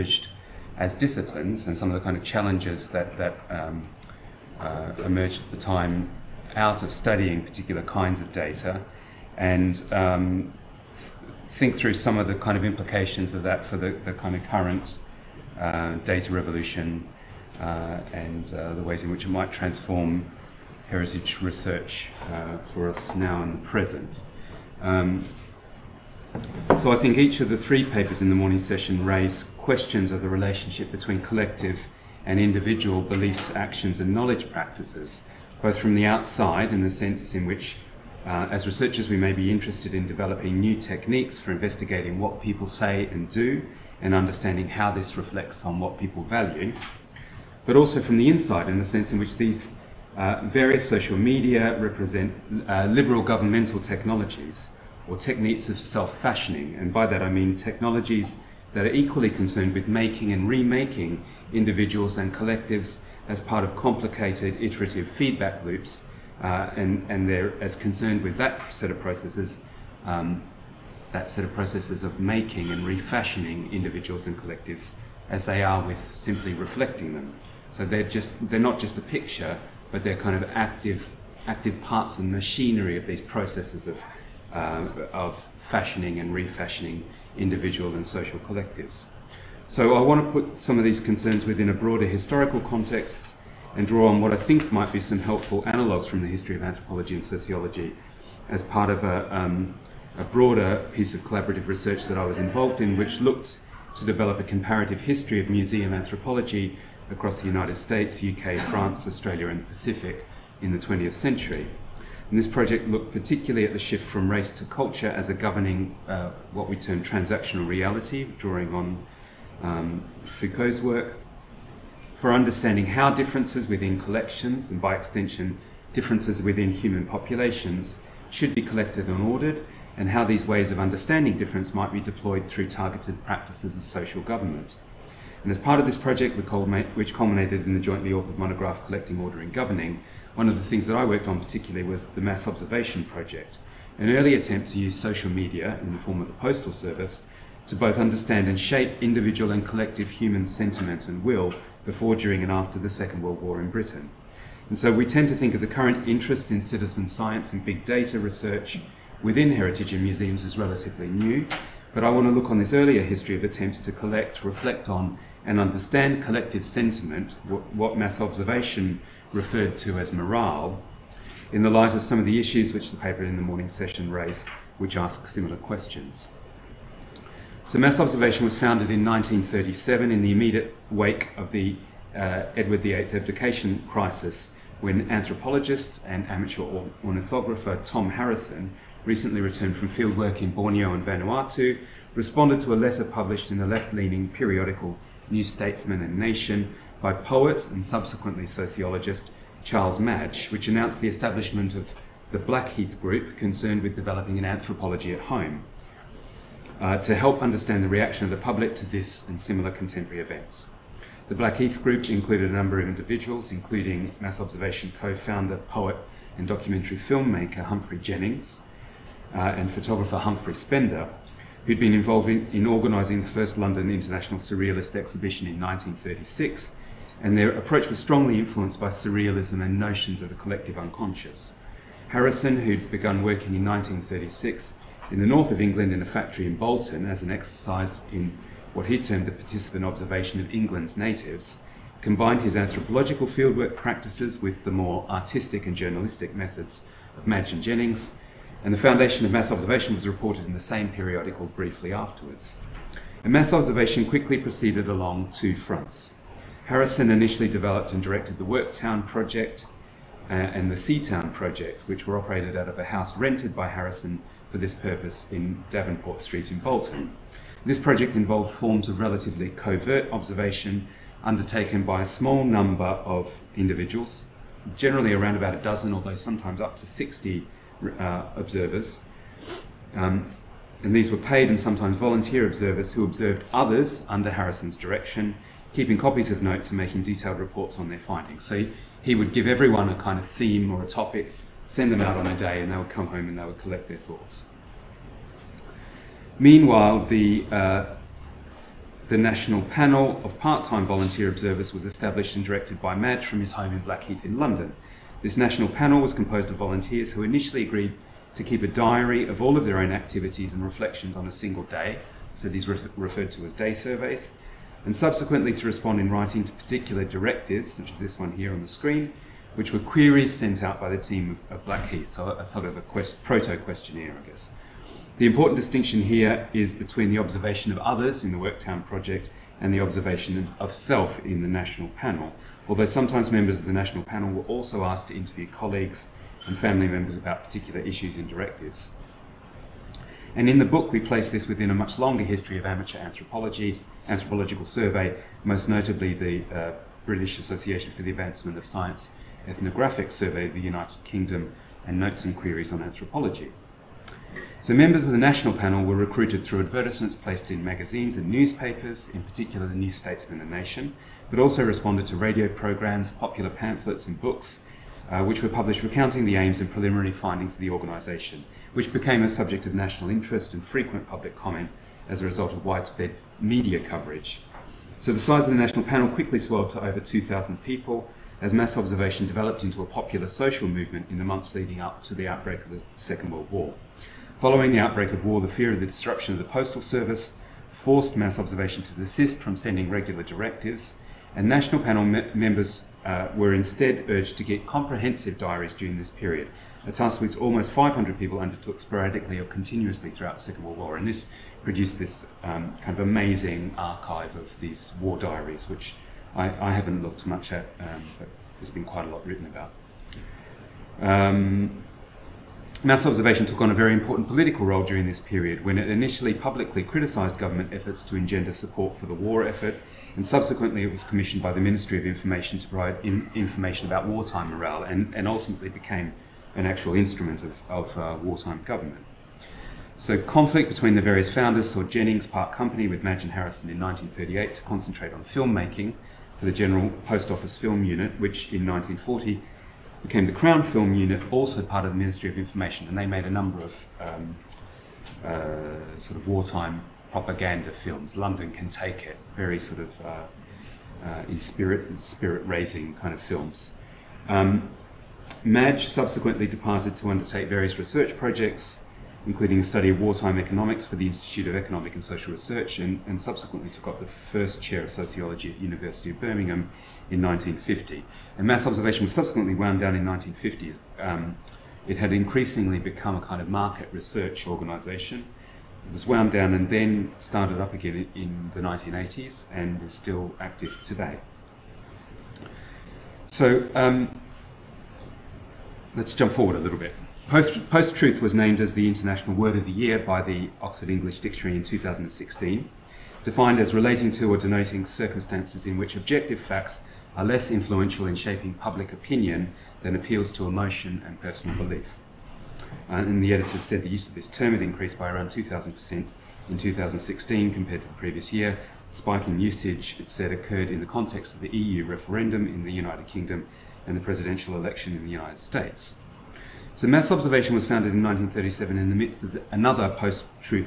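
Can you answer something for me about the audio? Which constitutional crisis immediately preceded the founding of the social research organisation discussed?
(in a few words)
Edward VIII abdication crisis.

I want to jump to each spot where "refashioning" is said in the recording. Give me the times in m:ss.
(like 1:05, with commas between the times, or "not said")
1:12, 1:26.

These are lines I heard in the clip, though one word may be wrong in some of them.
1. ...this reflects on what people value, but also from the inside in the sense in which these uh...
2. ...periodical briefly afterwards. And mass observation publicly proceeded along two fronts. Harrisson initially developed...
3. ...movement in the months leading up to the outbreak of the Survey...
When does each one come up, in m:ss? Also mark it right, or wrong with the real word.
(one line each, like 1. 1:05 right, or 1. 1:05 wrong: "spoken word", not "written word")
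1. 0:44 right
2. 4:10 wrong: "quickly", not "publicly"
3. 6:20 wrong: "Second", not "Survey".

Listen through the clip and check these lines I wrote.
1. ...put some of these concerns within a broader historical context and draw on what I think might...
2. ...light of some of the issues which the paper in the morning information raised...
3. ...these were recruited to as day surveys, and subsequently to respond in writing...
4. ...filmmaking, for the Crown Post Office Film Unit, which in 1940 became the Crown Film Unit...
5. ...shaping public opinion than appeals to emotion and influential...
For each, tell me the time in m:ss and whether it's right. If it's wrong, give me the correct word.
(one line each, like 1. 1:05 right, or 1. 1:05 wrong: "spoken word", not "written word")
1. 1:30 right
2. 2:51 wrong: "session", not "information"
3. 5:12 wrong: "referred", not "recruited"
4. 7:15 wrong: "General", not "Crown"
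5. 8:18 wrong: "personal", not "influential".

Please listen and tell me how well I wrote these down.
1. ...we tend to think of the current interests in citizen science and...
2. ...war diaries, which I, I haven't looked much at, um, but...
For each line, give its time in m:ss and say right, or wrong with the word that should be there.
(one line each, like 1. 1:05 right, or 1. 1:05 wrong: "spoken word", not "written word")
1. 2:34 right
2. 6:45 right.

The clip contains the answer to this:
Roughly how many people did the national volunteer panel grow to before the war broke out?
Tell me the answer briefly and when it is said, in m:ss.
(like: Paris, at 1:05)
over 2,000, at 6:16.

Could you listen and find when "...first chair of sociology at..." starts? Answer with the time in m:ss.
7:44.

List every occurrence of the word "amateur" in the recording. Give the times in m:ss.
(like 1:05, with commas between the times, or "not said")
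3:06, 5:42.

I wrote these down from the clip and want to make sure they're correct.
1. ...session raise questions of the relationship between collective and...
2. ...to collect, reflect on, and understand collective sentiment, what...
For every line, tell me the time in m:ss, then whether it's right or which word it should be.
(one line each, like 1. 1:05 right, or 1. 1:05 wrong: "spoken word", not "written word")
1. 0:28 right
2. 2:43 right.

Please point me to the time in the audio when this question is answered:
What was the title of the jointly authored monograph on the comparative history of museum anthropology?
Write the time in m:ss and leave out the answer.
2:18.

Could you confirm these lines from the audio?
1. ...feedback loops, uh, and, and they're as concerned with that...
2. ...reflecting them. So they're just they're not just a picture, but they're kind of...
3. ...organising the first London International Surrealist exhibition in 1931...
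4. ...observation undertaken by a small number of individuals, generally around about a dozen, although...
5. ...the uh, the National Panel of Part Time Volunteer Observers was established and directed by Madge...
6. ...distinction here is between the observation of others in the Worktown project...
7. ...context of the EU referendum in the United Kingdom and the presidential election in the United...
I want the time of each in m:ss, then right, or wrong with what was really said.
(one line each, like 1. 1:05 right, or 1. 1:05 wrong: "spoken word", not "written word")
1. 1:05 right
2. 1:16 right
3. 3:42 wrong: "1936", not "1931"
4. 4:30 right
5. 4:57 right
6. 5:25 right
7. 8:30 right.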